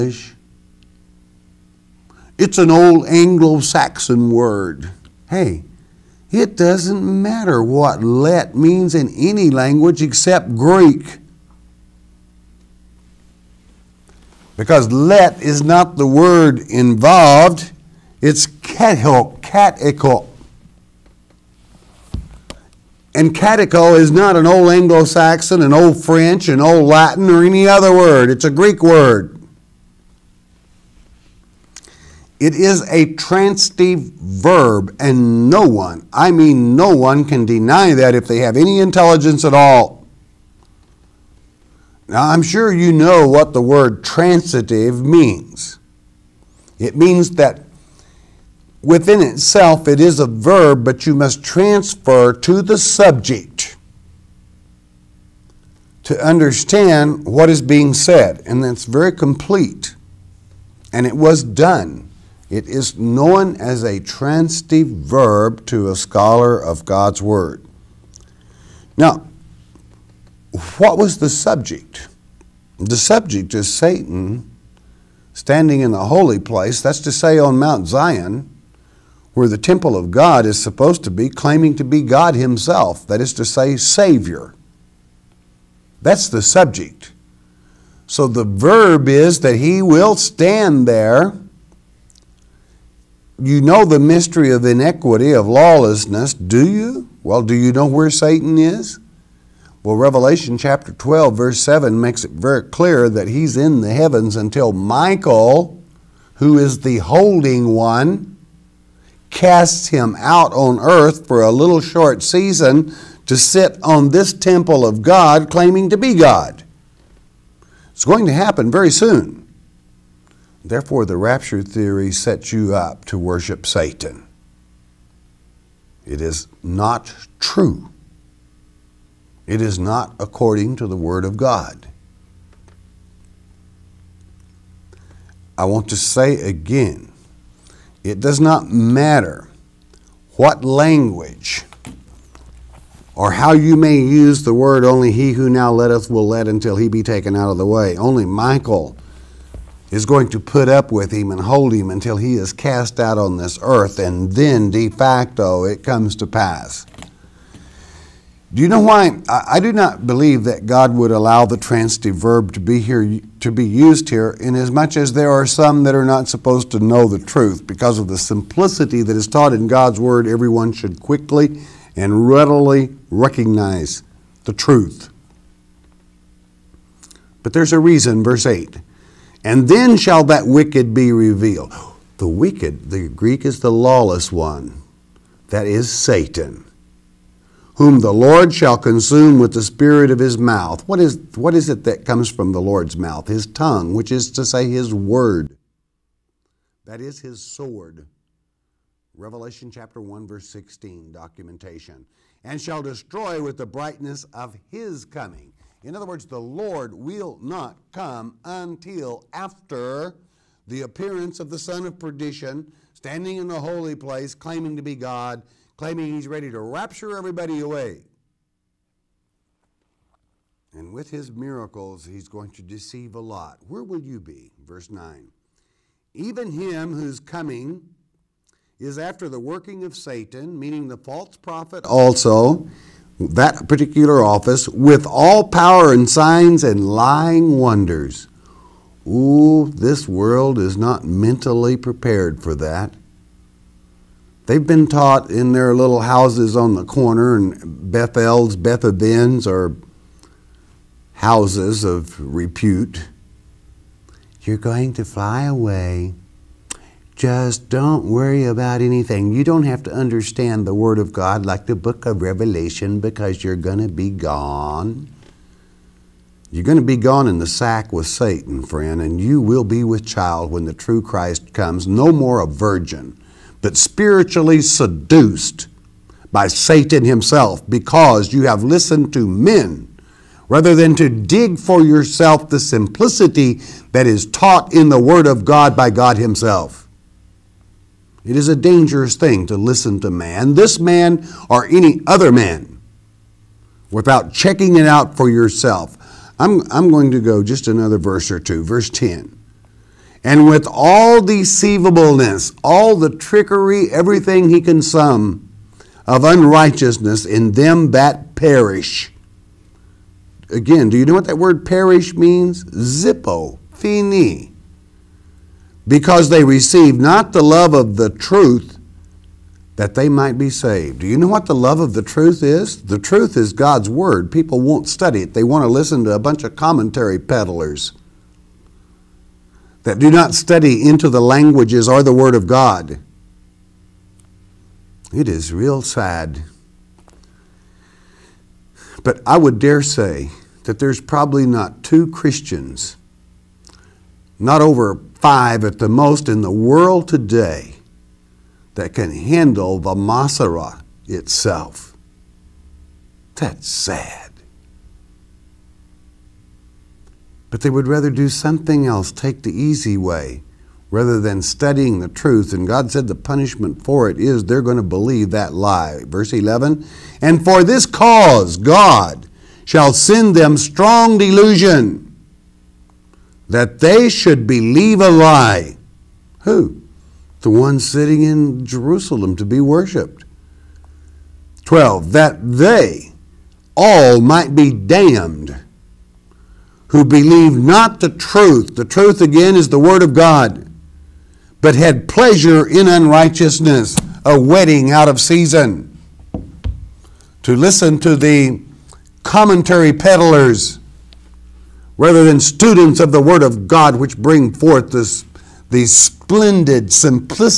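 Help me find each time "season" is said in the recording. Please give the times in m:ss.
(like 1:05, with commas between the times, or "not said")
1:52, 6:35.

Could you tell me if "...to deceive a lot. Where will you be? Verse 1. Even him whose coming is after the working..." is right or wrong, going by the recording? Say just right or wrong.
wrong.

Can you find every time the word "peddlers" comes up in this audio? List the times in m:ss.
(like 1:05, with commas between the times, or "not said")
5:27, 6:39.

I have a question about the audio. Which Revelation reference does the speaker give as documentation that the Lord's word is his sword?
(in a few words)
Revelation 1:16.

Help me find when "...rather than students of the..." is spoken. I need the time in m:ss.
6:41.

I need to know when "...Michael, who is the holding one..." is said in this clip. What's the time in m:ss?
1:44.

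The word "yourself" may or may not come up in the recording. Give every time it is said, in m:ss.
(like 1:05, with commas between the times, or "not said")
4:41, 4:55.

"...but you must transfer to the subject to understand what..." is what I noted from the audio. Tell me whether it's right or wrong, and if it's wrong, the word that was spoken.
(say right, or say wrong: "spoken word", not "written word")
right.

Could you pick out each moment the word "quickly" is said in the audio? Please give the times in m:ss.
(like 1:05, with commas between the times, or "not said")
2:50.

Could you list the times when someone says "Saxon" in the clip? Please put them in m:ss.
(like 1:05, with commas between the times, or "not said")
0:03, 0:25.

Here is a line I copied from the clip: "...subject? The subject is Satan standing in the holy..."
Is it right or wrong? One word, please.
right.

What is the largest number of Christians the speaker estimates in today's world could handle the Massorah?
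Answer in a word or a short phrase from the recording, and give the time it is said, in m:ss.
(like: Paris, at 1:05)
5, at 5:45.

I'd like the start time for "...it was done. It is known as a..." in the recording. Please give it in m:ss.
1:01.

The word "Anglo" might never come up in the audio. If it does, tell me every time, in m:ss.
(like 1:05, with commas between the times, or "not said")
0:03, 0:24.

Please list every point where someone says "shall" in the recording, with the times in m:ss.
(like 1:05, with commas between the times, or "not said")
2:59, 3:08, 3:22, 6:09.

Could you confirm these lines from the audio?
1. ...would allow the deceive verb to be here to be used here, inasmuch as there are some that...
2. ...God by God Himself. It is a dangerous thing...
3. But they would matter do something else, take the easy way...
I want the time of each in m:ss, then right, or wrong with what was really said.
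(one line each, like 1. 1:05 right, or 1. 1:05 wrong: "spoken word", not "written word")
1. 2:40 wrong: "transitive", not "deceive"
2. 4:45 right
3. 5:57 wrong: "rather", not "matter".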